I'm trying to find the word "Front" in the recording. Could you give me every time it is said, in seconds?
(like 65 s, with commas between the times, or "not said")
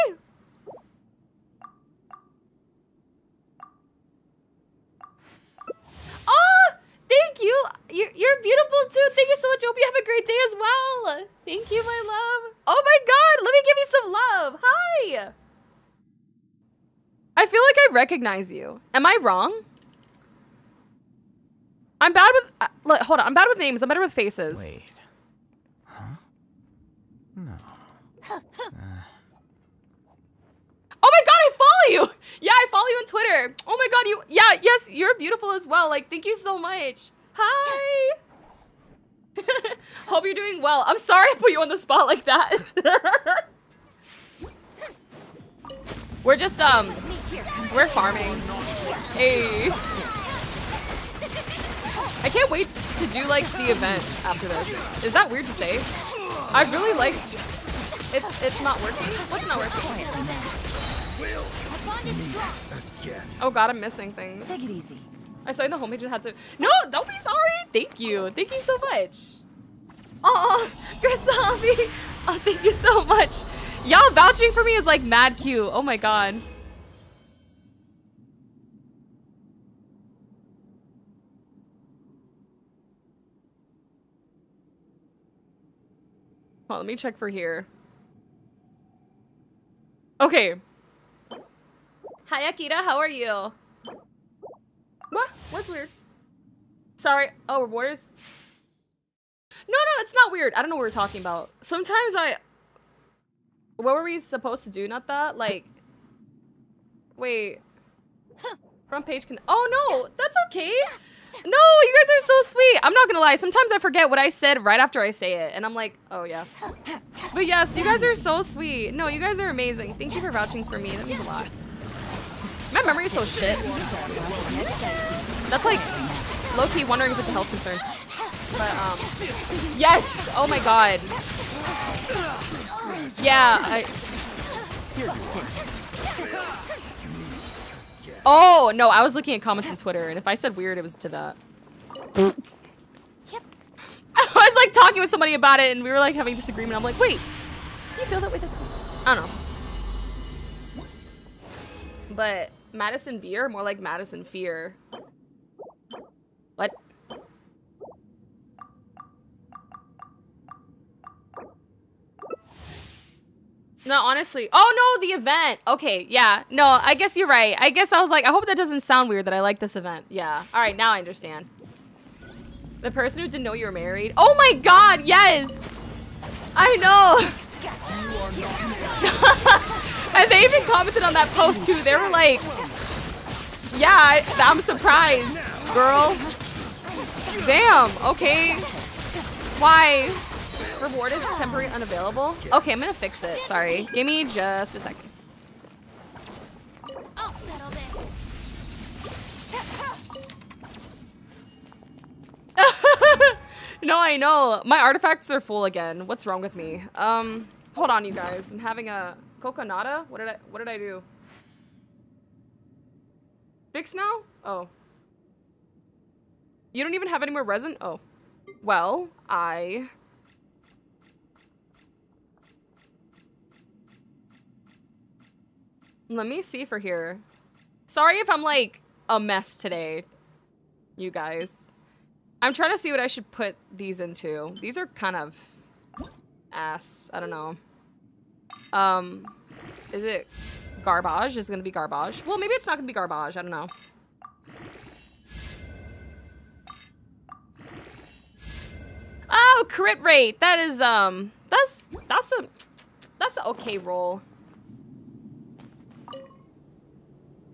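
108 s.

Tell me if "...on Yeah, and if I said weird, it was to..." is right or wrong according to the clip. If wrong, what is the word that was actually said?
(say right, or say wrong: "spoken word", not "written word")
wrong: "Twitter", not "Yeah".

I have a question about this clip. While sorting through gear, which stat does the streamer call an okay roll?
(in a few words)
Crit rate.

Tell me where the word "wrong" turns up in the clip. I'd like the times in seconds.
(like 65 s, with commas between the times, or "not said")
19 s, 206 s.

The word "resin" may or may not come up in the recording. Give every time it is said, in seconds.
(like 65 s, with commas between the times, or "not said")
217 s.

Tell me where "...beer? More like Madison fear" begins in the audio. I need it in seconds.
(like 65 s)
153 s.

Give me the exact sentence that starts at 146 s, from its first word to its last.
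I'm like, wait, you feel that way?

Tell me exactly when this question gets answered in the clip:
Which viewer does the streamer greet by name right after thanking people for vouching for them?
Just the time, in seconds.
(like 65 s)
92 s.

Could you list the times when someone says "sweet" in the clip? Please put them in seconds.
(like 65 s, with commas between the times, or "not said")
112 s, 118 s.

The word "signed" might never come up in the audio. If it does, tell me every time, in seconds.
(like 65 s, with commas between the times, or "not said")
65 s.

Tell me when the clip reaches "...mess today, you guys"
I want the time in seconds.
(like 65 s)
229 s.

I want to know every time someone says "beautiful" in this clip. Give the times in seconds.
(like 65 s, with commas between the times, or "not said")
8 s, 35 s.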